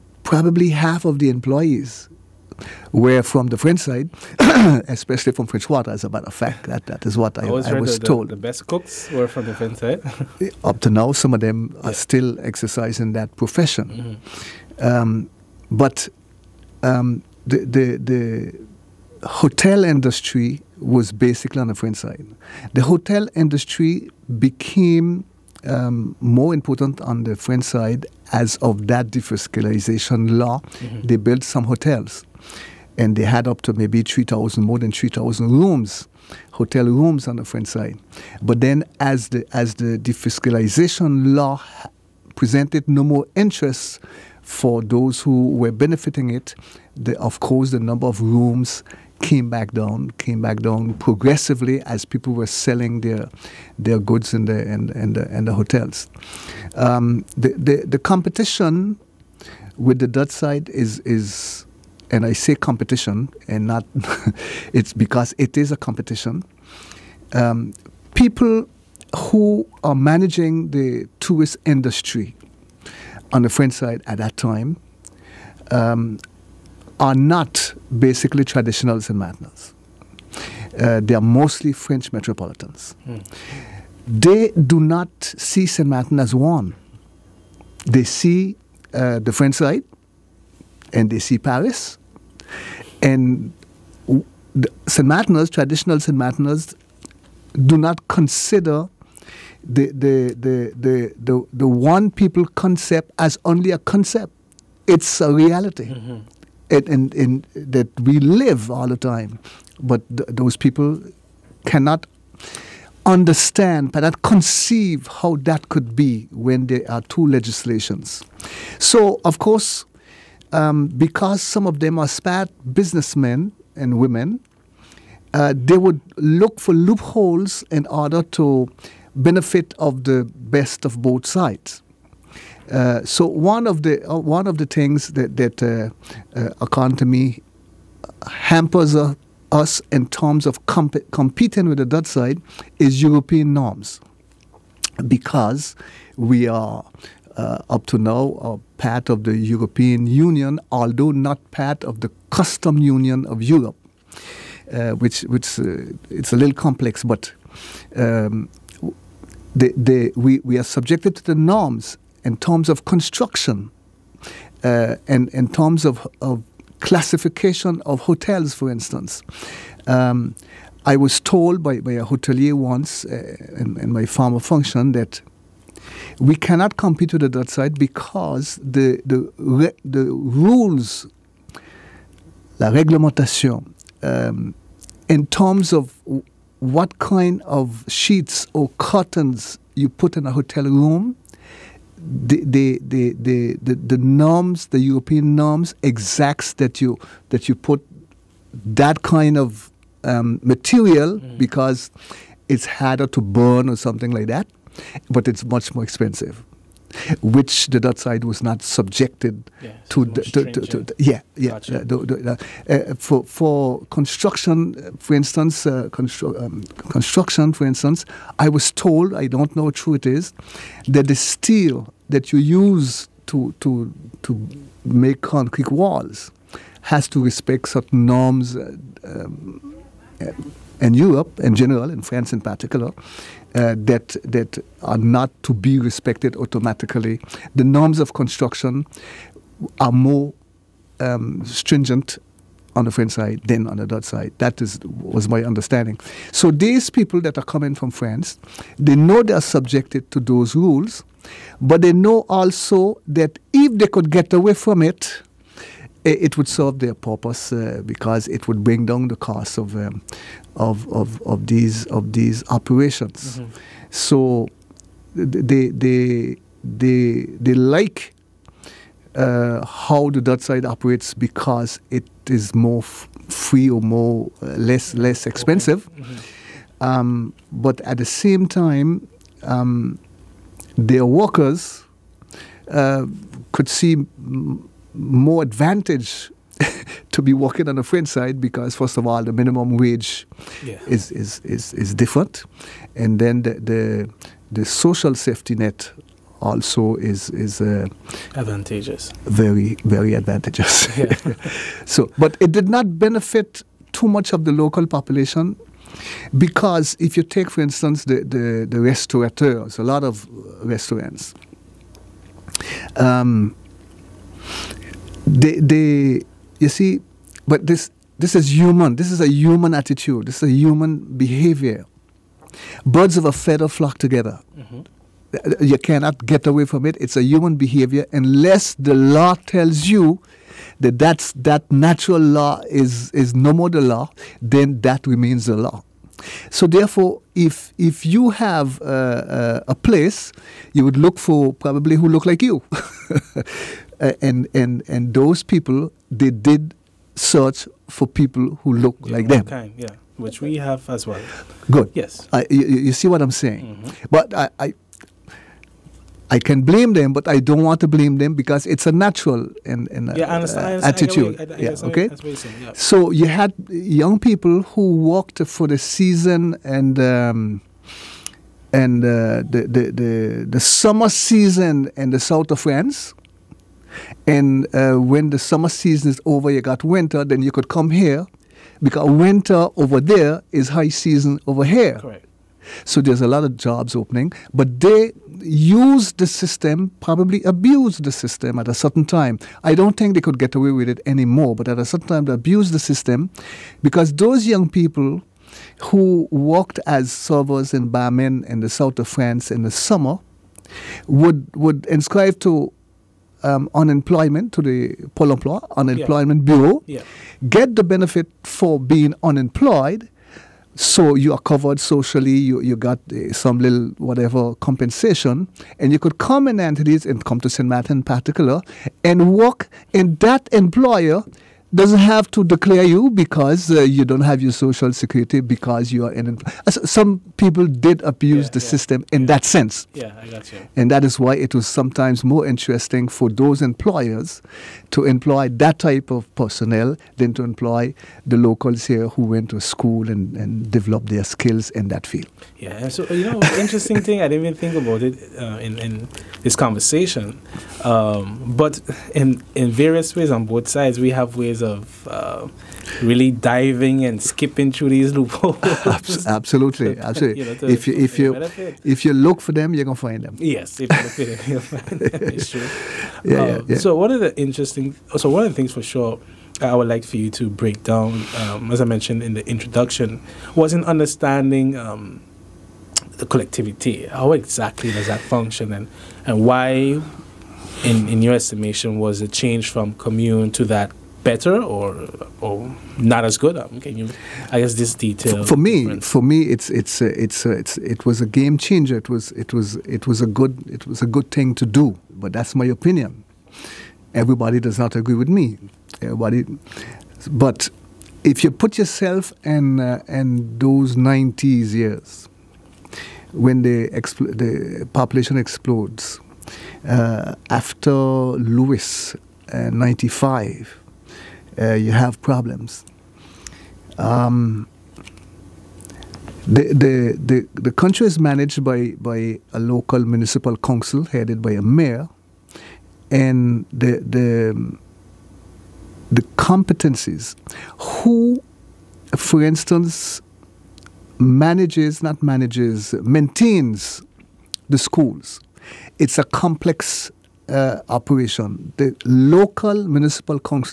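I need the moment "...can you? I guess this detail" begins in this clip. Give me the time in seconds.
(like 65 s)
483 s.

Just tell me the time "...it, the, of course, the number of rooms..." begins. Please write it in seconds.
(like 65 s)
46 s.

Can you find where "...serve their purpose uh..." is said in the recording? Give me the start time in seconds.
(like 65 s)
256 s.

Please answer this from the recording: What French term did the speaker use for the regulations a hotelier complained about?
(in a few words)
la réglementation.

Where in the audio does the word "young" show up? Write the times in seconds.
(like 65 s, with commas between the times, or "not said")
363 s, 394 s.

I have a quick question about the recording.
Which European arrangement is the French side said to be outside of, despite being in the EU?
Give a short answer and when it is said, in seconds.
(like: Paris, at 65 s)
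Custom Union, at 152 s.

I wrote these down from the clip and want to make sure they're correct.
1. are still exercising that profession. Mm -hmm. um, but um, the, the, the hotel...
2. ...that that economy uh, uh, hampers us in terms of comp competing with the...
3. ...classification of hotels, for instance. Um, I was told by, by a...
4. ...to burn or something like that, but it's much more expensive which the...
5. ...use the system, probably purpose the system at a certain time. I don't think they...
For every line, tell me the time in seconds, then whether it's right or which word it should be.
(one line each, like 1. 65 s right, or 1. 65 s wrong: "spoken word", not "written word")
1. 11 s right
2. 135 s right
3. 166 s right
4. 203 s right
5. 385 s wrong: "abuse", not "purpose".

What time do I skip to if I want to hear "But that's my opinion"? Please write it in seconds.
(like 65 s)
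492 s.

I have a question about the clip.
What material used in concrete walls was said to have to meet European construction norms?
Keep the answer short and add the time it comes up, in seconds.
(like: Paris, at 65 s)
steel, at 221 s.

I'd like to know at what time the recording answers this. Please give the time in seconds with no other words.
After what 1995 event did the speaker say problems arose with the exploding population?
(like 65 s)
508 s.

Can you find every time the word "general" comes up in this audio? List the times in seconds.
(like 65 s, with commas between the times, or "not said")
231 s.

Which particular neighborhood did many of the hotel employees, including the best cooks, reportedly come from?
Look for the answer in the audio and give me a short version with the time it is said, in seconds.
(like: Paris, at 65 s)
French Quarter, at 5 s.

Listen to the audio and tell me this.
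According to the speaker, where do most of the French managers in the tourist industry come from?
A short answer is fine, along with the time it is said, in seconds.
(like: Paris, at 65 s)
French metropolitans, at 81 s.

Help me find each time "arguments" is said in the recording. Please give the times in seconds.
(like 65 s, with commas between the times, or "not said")
not said.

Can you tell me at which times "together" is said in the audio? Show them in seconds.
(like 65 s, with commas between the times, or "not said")
323 s.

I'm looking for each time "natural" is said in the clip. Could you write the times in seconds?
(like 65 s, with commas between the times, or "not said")
331 s, 358 s.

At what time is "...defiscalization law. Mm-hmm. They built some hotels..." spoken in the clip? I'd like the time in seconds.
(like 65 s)
29 s.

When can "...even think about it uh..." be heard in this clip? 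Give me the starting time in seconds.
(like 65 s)
444 s.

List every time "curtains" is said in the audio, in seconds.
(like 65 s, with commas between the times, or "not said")
188 s.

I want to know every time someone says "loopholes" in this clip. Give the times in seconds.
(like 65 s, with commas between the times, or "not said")
126 s, 455 s.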